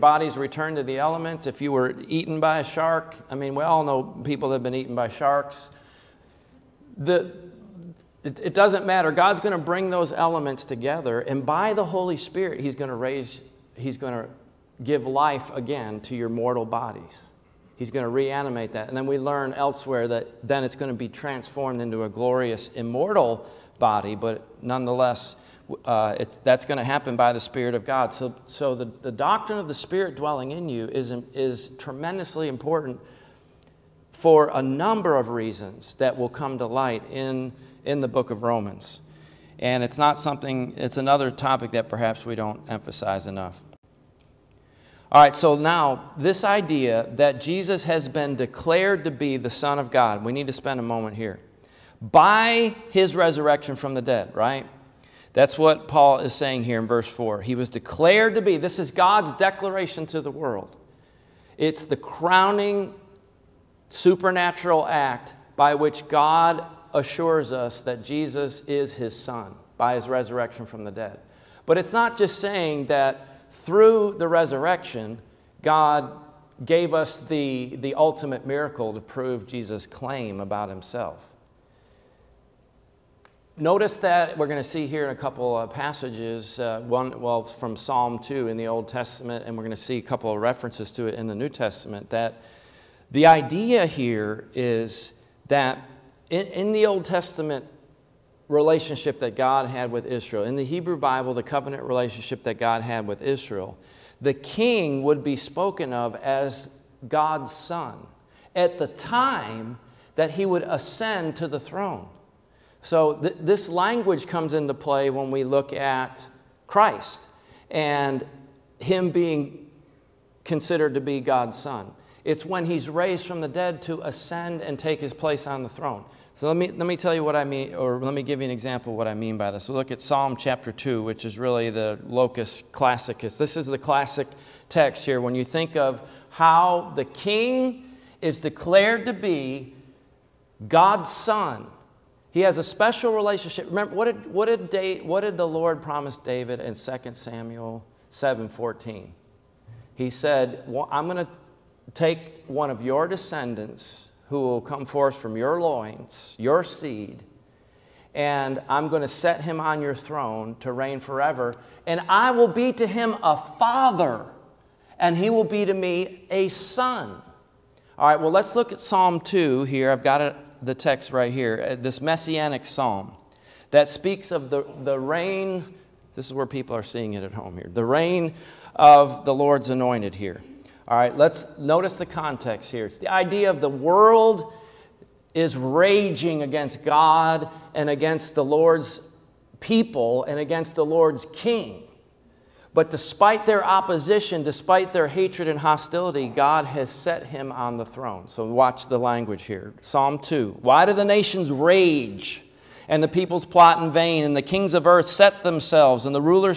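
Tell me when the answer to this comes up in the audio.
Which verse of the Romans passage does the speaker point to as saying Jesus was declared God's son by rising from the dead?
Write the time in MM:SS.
00:56.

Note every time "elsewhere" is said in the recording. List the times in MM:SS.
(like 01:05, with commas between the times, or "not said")
00:19.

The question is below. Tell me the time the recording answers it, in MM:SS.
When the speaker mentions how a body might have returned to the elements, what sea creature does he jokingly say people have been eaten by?
00:05.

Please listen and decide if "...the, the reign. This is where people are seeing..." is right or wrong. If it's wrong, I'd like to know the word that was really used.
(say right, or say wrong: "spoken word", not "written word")
right.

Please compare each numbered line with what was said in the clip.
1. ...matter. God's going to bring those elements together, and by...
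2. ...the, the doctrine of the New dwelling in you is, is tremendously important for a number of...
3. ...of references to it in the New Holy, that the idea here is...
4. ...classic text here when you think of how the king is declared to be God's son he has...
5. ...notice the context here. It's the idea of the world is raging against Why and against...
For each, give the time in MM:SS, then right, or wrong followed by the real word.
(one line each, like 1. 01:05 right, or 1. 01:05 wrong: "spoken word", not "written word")
1. 00:08 right
2. 00:28 wrong: "Spirit", not "New"
3. 01:30 wrong: "Testament", not "Holy"
4. 02:13 right
5. 03:01 wrong: "God", not "Why".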